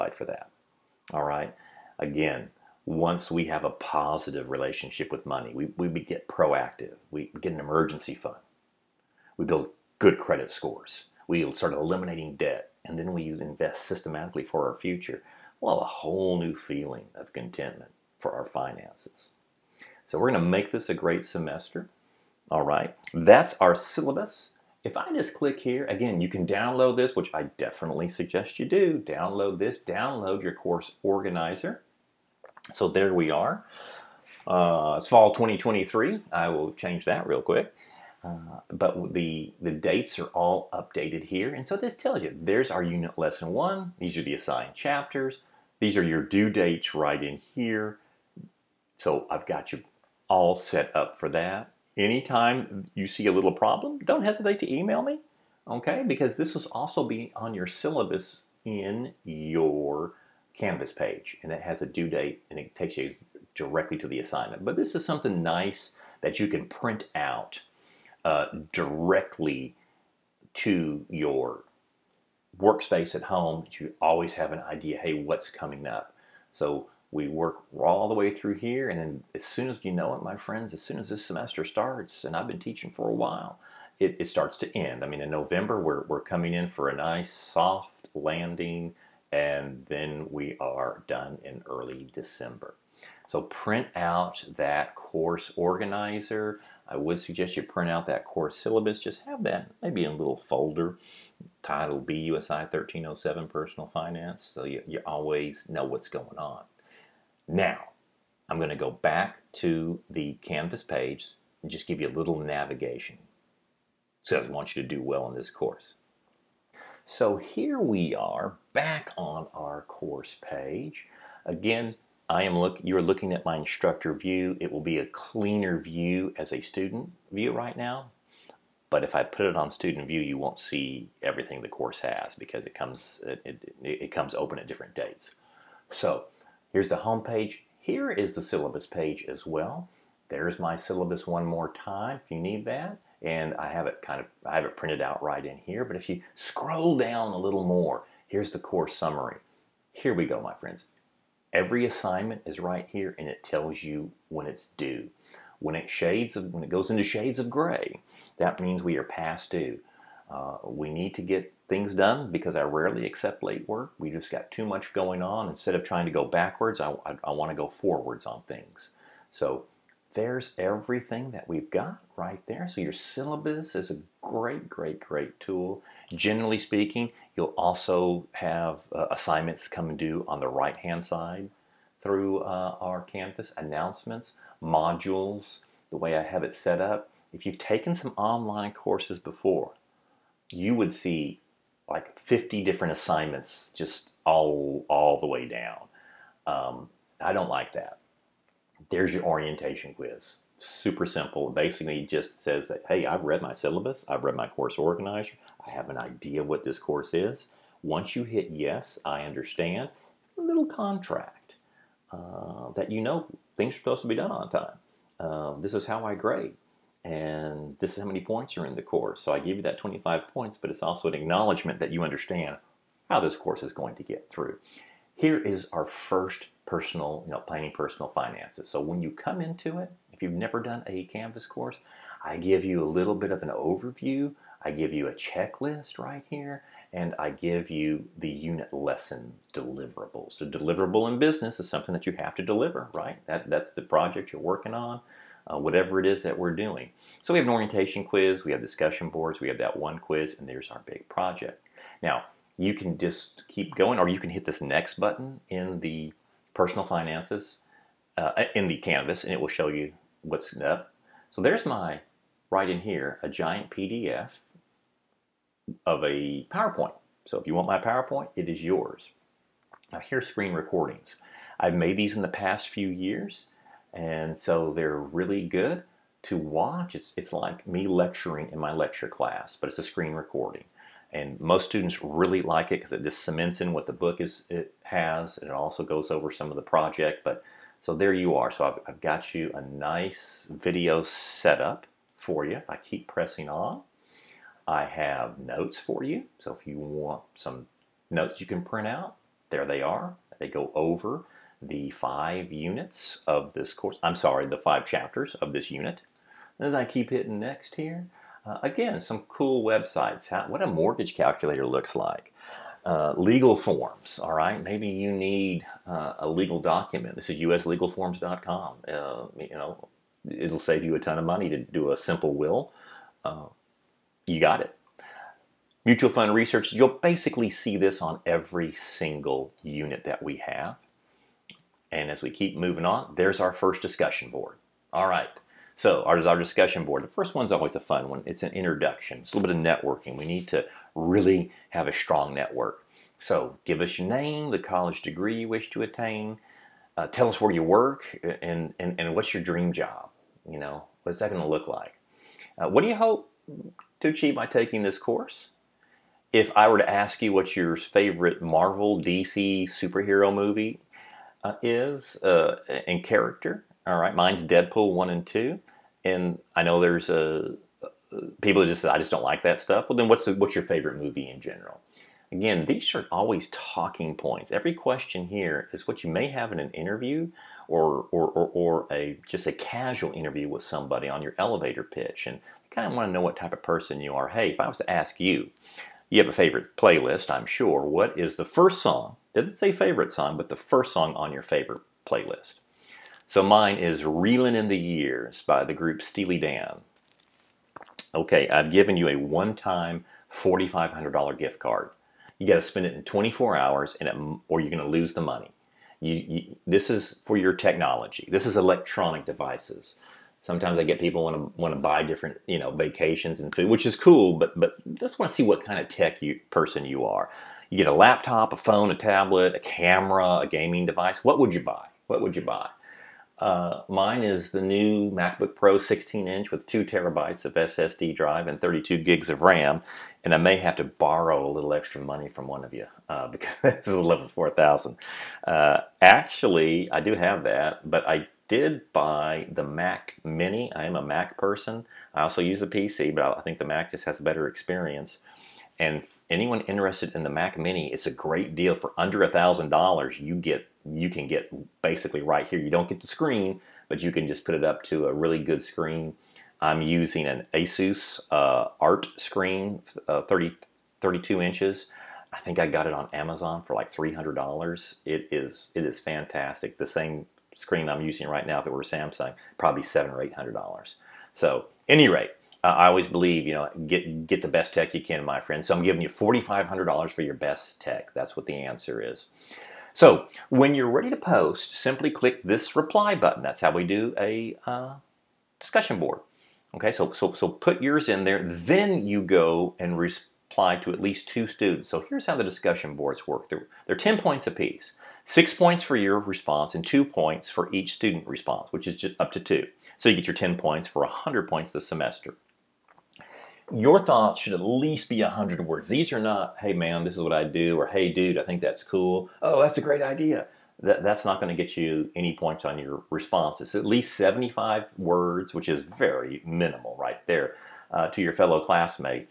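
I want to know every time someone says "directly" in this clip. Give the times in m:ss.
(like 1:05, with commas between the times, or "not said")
1:03, 1:08.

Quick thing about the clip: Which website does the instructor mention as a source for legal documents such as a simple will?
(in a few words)
uslegalforms.com.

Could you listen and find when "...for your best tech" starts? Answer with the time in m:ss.
7:57.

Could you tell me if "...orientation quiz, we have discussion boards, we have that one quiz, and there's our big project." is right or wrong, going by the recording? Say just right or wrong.
right.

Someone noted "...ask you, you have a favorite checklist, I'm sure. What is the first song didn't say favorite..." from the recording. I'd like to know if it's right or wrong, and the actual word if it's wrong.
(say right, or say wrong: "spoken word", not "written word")
wrong: "playlist", not "checklist".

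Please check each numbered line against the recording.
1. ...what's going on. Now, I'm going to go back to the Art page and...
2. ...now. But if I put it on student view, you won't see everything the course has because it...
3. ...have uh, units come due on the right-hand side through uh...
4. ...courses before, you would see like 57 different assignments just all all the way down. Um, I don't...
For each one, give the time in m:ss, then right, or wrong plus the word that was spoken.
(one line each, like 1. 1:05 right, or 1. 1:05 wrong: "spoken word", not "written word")
1. 1:45 wrong: "Canvas", not "Art"
2. 2:07 right
3. 2:58 wrong: "assignments", not "units"
4. 3:08 wrong: "50", not "57".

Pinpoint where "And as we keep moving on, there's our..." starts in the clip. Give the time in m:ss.
5:31.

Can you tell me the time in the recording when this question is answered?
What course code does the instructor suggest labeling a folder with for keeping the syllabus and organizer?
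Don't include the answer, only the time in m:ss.
1:42.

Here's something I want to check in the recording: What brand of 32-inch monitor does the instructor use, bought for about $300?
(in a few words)
Asus.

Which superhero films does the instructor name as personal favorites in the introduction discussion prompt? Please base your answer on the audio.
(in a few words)
Deadpool one and two.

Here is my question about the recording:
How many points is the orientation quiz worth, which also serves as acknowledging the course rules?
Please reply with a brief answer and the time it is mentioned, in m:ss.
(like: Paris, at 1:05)
25, at 3:39.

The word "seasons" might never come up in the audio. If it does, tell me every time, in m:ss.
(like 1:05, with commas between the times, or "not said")
not said.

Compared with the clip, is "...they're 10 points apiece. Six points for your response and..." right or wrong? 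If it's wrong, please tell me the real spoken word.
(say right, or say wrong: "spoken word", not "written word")
right.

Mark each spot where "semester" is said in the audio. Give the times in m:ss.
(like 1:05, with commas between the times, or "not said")
0:21, 1:21, 8:21.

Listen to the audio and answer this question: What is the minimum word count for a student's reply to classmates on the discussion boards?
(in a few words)
75.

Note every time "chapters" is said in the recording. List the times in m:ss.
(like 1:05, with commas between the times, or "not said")
0:44, 5:04.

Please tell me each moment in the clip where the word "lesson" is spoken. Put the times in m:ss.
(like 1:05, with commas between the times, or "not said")
0:43, 3:58.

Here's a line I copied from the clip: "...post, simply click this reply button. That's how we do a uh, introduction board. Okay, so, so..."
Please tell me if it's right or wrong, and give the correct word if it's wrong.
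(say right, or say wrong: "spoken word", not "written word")
wrong: "discussion", not "introduction".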